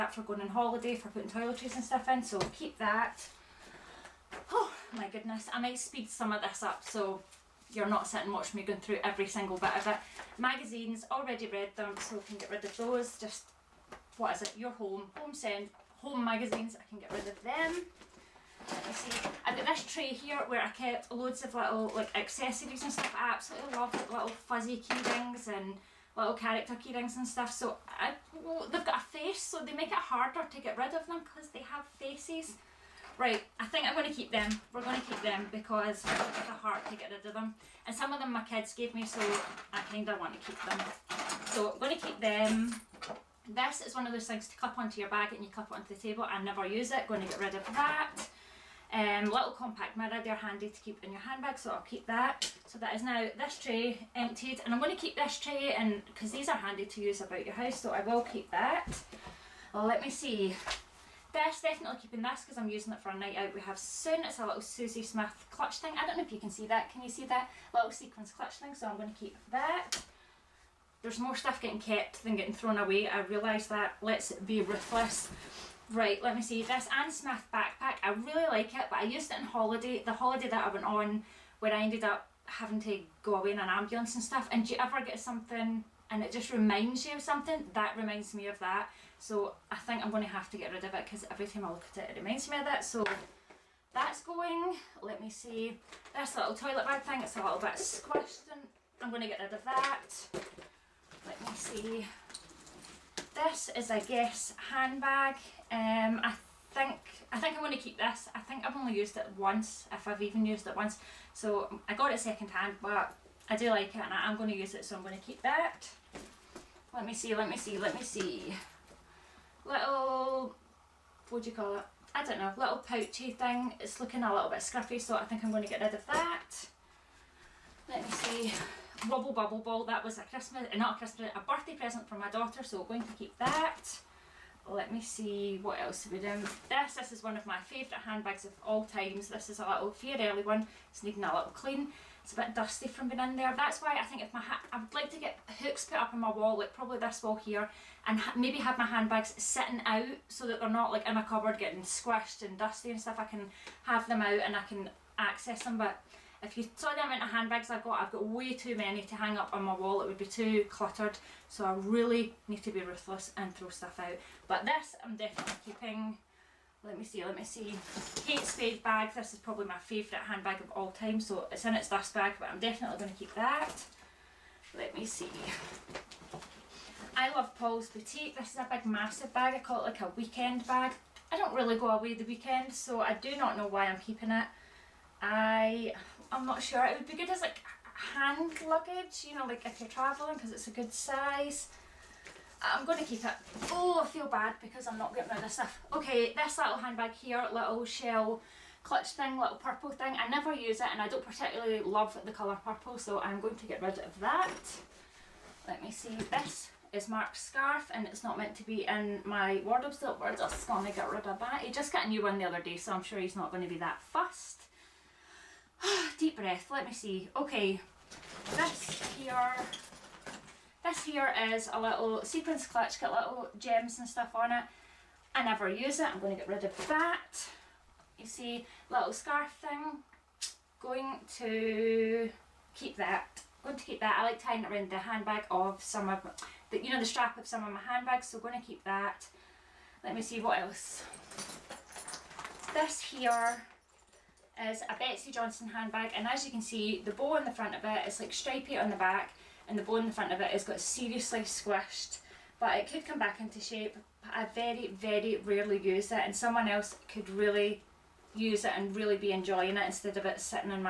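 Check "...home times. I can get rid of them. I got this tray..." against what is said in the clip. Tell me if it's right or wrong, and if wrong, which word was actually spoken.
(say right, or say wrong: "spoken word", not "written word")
wrong: "magazines", not "times".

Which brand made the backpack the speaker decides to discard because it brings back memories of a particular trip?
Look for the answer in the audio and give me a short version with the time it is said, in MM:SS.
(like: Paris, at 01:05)
Anne Smith, at 01:16.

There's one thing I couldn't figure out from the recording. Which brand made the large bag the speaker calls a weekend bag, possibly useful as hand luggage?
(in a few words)
Paul's Boutique.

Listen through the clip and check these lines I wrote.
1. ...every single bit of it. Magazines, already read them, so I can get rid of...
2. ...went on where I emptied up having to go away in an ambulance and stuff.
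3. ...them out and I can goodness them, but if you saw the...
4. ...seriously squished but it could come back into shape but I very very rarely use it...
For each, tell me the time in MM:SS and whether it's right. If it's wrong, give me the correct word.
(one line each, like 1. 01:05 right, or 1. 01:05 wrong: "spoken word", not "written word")
1. 00:09 right
2. 01:20 wrong: "ended", not "emptied"
3. 02:34 wrong: "access", not "goodness"
4. 04:10 right.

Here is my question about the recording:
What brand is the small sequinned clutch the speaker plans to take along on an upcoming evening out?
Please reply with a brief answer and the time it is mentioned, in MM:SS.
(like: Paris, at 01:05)
Susie Smith, at 01:04.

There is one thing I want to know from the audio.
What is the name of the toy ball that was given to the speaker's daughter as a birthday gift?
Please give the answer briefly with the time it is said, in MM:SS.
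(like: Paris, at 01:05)
Wubble Bubble Ball, at 02:09.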